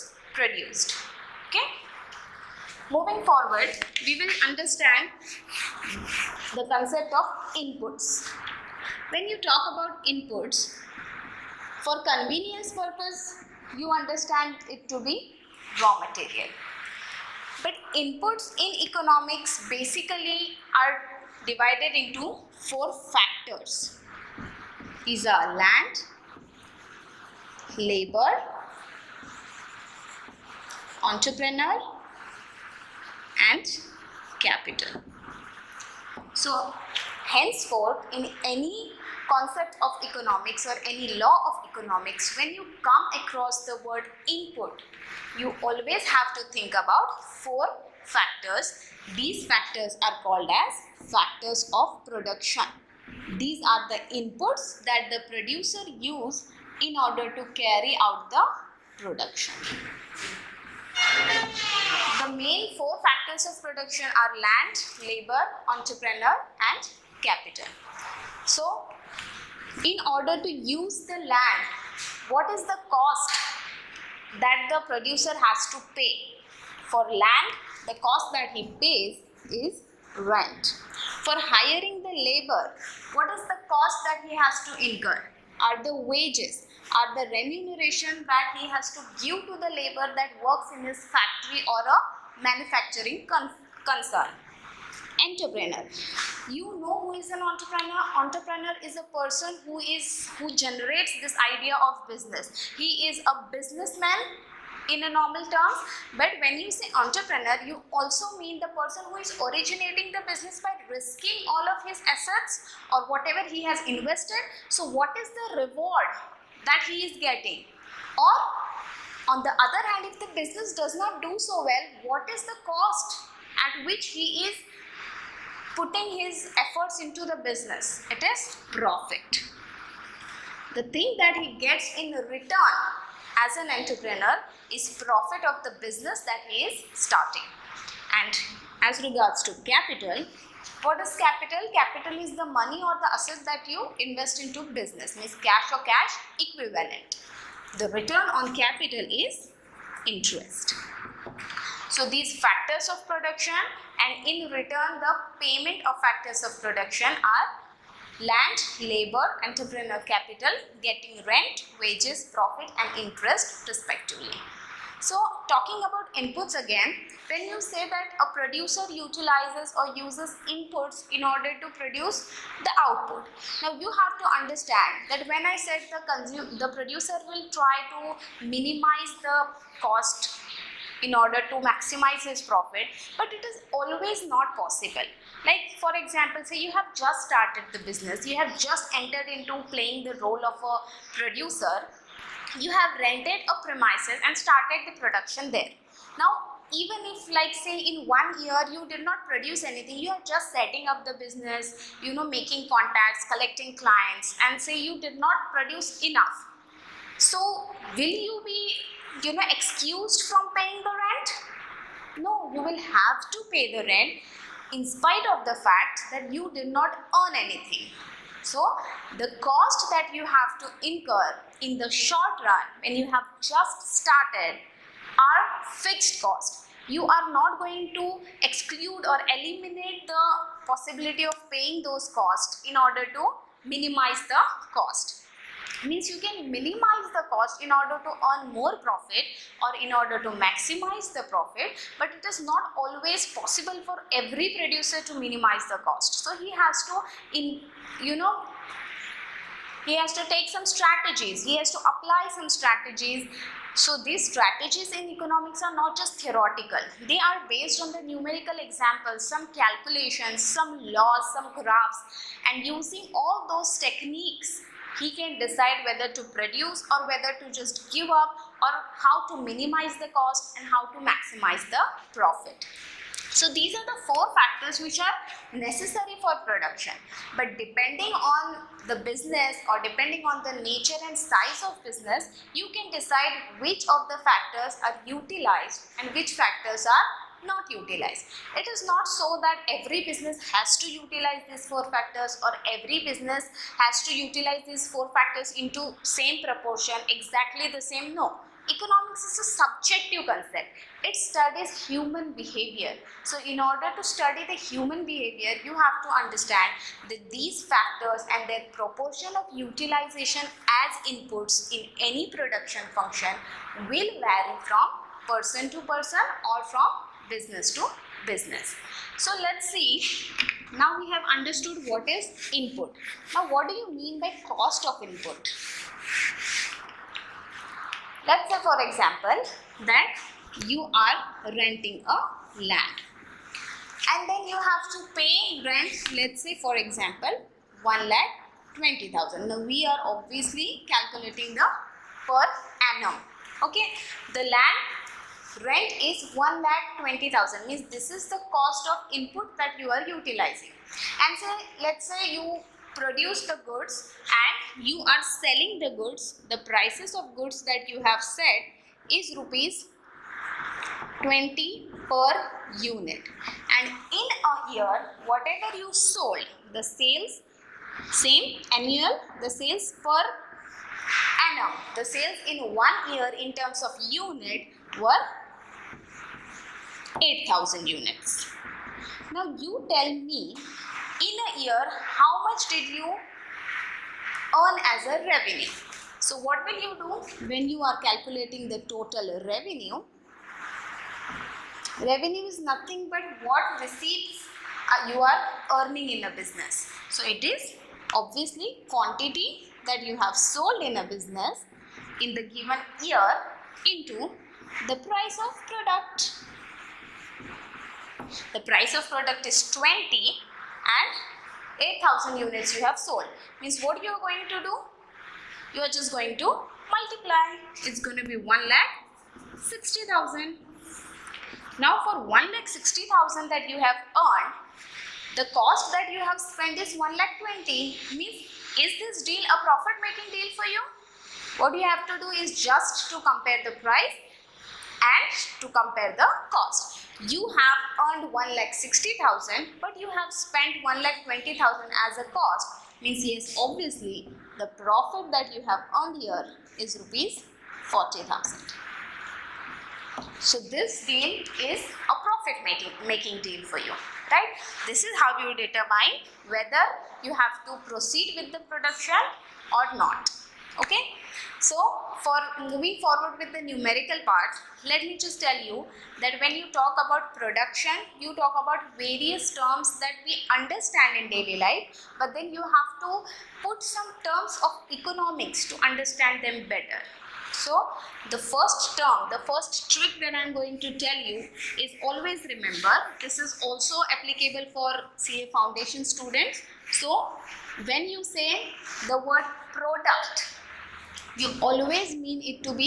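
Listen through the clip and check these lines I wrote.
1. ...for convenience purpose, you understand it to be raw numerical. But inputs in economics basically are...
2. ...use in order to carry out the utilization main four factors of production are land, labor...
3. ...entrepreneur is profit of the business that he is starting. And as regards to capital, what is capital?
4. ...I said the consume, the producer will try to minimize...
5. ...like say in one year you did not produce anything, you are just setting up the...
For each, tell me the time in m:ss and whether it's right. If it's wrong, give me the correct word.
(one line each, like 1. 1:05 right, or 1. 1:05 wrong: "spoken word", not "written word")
1. 0:11 wrong: "material", not "numerical"
2. 0:55 wrong: "production", not "utilization"
3. 2:13 right
4. 2:55 right
5. 3:17 right.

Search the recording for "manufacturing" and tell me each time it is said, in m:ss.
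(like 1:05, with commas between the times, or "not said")
1:32.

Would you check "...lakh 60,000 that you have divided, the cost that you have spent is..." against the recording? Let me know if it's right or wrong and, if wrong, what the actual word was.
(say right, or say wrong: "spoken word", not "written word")
wrong: "earned", not "divided".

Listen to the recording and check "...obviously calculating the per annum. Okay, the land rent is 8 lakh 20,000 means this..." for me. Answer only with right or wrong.
wrong.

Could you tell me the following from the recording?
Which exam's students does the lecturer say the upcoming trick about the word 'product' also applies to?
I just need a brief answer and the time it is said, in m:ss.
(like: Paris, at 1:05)
CA Foundation, at 8:05.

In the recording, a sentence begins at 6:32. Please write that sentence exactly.
Revenue is nothing but what receipts uh, you are earning in a business.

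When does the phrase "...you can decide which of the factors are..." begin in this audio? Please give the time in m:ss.
4:42.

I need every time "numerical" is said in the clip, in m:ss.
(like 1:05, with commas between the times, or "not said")
4:18, 7:43.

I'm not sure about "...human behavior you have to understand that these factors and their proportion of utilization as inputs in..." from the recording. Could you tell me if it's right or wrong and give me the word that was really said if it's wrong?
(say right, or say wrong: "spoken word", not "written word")
right.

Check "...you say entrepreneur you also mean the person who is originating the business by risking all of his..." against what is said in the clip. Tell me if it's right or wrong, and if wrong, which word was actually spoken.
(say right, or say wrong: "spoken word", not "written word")
right.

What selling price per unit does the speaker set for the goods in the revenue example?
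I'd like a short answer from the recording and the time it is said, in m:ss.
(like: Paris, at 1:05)
Rupees 20, at 5:59.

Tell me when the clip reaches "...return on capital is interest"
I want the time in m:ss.
2:27.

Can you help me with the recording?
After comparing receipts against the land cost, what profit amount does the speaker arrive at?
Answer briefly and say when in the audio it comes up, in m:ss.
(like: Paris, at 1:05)
Rupees 40,000, at 7:26.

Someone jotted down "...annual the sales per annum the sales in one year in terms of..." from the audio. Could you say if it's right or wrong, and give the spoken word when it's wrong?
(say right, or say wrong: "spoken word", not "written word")
right.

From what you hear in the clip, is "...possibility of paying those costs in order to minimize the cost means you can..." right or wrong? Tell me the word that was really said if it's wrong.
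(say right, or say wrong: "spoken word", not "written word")
right.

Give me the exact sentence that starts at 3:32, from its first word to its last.
No, you will have to pay the rent in spite of the fact that you did not earn anything.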